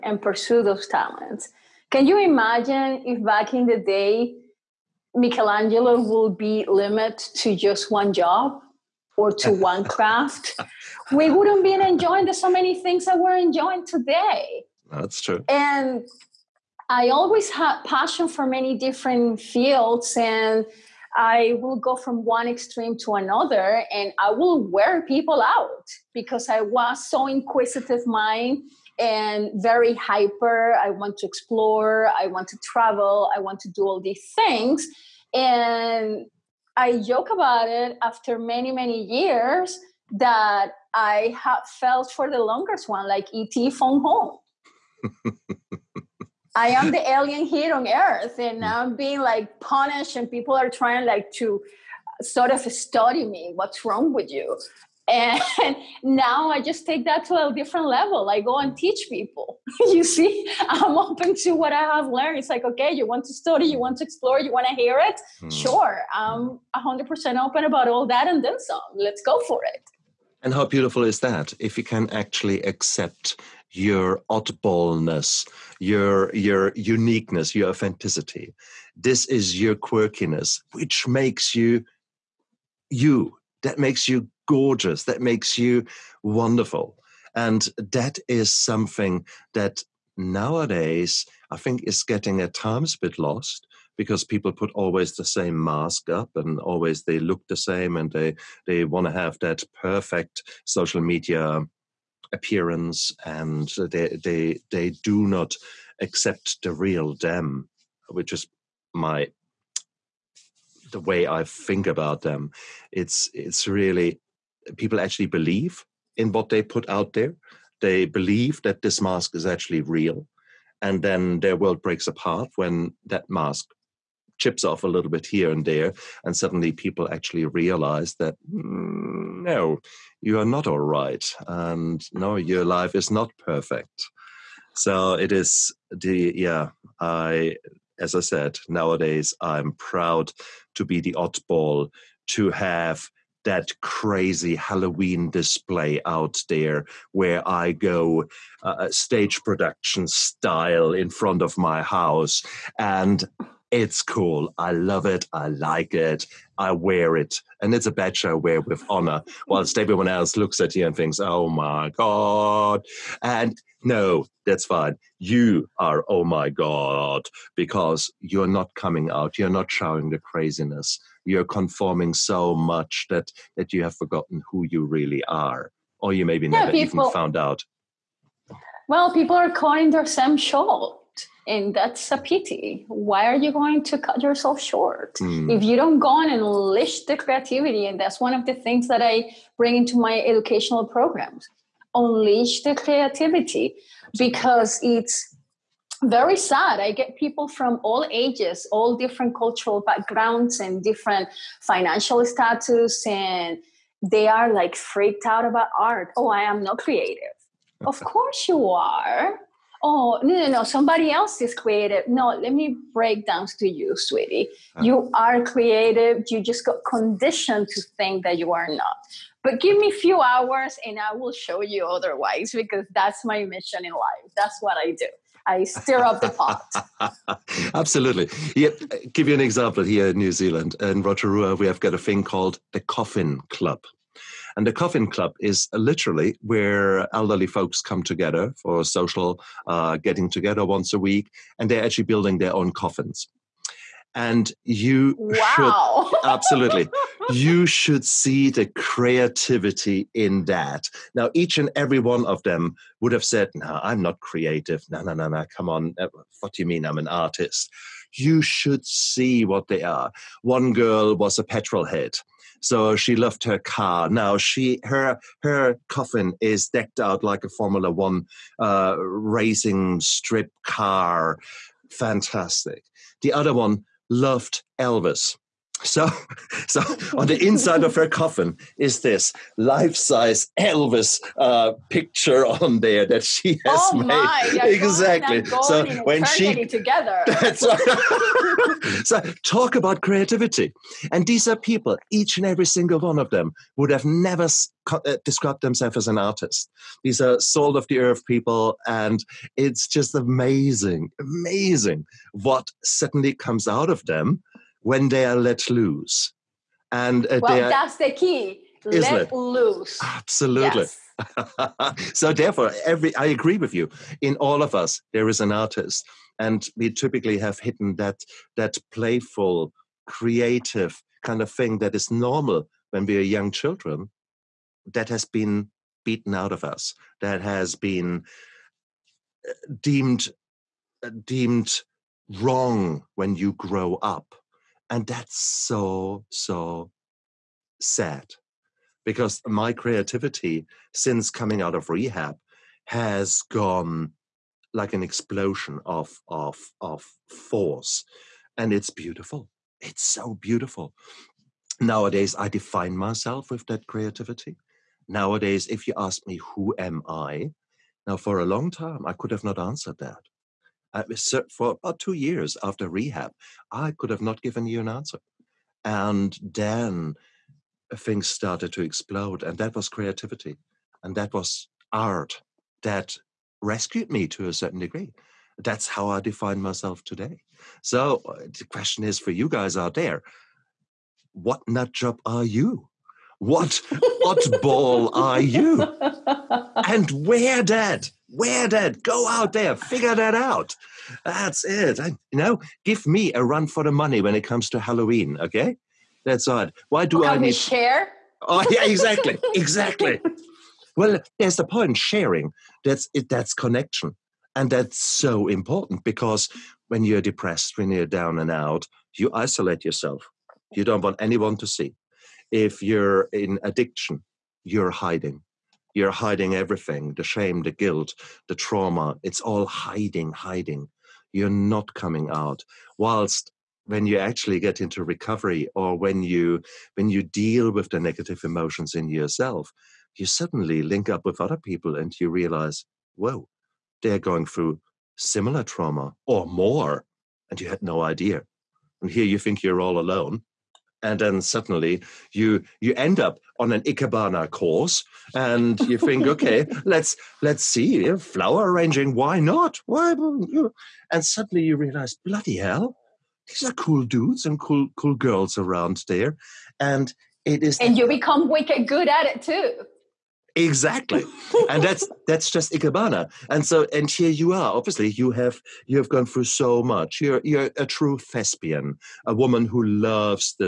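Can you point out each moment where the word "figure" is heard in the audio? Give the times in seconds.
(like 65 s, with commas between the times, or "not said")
389 s.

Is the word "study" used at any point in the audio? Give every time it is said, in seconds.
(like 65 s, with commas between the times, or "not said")
52 s, 63 s.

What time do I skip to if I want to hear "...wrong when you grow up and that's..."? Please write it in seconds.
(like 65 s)
332 s.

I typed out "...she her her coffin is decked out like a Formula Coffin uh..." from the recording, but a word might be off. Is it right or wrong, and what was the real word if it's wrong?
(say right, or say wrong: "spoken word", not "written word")
wrong: "One", not "Coffin".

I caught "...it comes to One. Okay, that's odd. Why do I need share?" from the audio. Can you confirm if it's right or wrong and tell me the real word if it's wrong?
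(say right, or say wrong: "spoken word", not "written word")
wrong: "Halloween", not "One".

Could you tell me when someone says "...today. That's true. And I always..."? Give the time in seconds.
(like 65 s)
13 s.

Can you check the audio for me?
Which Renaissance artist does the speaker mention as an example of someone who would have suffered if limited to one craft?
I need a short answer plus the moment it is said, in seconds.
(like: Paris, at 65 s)
Michelangelo, at 5 s.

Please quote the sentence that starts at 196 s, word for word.
I get people from all ages, all different cultural backgrounds and different financial status, and they are like freaked out about art.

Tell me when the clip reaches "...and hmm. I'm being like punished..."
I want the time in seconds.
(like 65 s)
48 s.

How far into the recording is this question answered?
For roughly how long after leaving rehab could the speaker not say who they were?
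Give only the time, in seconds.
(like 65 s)
361 s.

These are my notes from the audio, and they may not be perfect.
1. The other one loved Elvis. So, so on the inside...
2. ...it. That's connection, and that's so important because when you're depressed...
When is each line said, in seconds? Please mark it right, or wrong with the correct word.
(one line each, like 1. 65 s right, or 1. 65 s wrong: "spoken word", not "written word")
1. 273 s right
2. 403 s right.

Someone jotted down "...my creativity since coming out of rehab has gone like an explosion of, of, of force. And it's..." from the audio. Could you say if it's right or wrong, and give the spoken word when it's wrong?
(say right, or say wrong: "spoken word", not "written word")
right.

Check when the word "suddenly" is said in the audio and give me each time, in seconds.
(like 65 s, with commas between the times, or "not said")
126 s, 302 s, 430 s, 441 s, 451 s.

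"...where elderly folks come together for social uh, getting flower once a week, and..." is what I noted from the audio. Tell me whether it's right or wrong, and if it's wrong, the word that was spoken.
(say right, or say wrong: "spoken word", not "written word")
wrong: "together", not "flower".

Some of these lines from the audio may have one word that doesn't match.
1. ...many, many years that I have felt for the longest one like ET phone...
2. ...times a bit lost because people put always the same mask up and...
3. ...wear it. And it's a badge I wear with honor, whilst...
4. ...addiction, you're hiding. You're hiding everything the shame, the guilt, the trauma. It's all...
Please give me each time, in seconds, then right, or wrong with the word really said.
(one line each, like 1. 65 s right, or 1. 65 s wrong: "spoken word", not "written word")
1. 38 s right
2. 92 s right
3. 156 s right
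4. 413 s right.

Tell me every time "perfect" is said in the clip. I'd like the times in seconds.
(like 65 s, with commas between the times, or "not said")
99 s, 133 s.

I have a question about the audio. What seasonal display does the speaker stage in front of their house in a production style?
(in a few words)
Halloween display.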